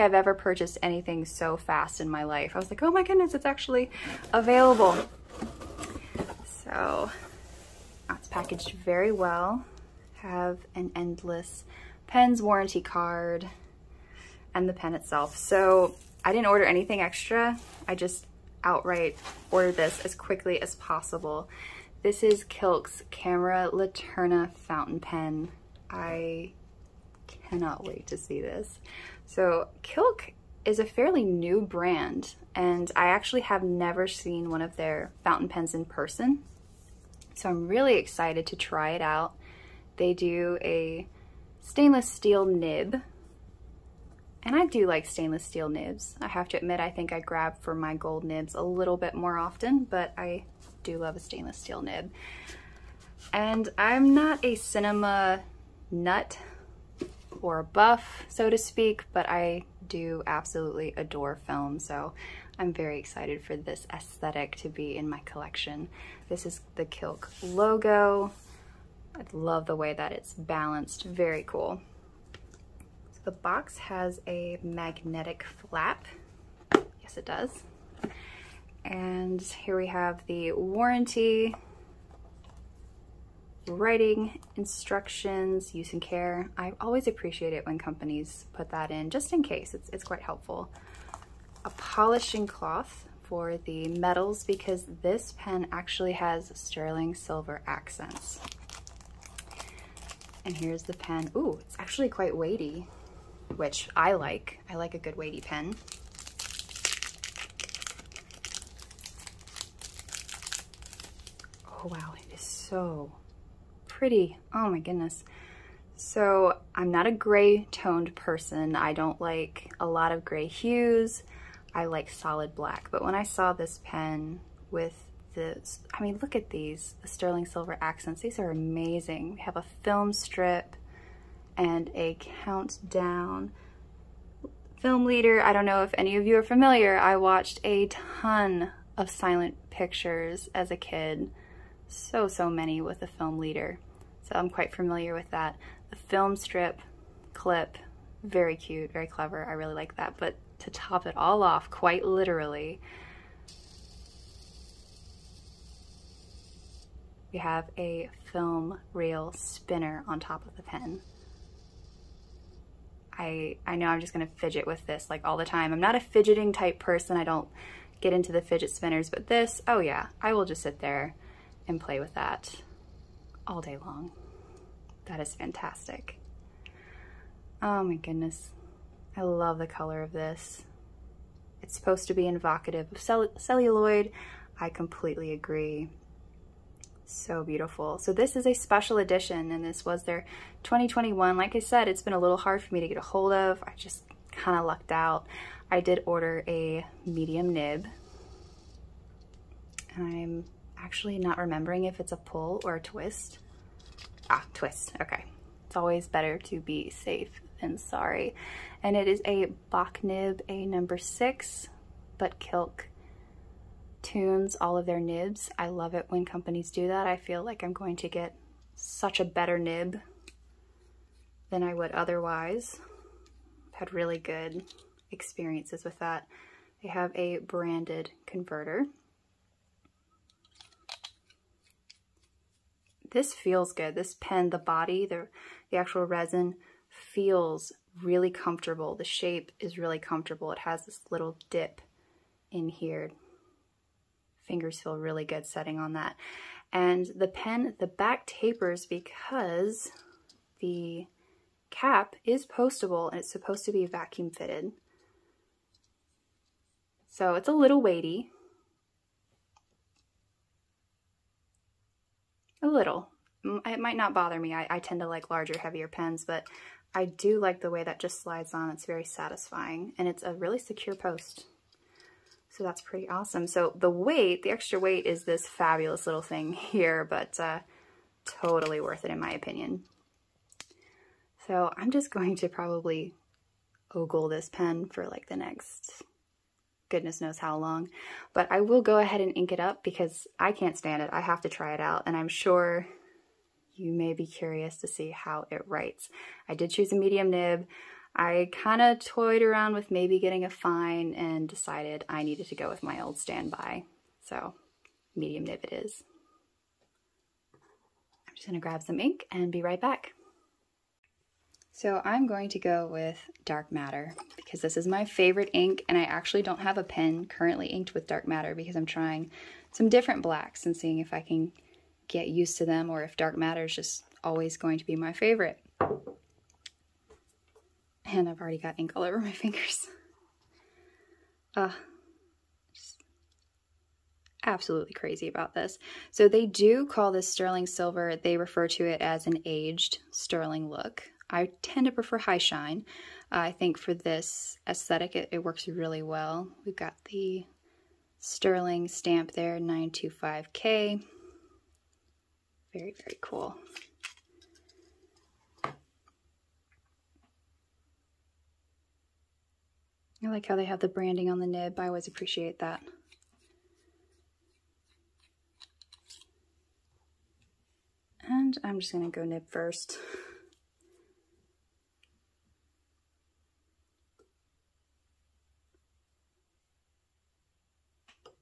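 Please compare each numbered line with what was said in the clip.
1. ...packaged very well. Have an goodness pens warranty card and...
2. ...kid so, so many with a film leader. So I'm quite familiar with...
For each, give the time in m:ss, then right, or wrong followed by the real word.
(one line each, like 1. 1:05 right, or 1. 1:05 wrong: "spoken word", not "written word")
1. 0:08 wrong: "endless", not "goodness"
2. 2:20 right.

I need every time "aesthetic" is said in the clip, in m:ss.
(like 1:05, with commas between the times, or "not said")
1:03, 5:44.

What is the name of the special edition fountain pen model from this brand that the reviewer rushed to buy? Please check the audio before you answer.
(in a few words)
Camera Laterna.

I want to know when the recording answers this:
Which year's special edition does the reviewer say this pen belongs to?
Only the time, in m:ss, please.
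3:10.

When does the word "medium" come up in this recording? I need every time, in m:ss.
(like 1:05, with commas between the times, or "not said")
3:17, 4:56, 5:05.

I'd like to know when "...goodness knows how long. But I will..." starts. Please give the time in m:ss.
4:46.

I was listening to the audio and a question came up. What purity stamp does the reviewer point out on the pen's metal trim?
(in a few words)
925K.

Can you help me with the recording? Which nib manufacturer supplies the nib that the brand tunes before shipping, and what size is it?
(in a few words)
Bock, number 6.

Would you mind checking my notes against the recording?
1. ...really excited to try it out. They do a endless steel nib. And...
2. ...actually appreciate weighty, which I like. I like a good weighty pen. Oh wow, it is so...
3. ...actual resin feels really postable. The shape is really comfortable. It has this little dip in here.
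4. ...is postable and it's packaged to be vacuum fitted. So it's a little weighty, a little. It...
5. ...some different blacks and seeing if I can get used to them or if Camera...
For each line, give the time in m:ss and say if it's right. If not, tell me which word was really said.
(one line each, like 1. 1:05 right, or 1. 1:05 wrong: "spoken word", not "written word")
1. 0:37 wrong: "stainless", not "endless"
2. 1:41 wrong: "quite", not "appreciate"
3. 3:55 wrong: "comfortable", not "postable"
4. 4:12 wrong: "supposed", not "packaged"
5. 5:19 wrong: "Dark", not "Camera".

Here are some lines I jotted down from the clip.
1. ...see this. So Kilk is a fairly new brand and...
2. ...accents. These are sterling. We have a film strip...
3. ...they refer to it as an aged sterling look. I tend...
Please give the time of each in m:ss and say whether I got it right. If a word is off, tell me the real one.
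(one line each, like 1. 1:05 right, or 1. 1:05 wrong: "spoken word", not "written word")
1. 0:28 right
2. 2:07 wrong: "amazing", not "sterling"
3. 5:38 right.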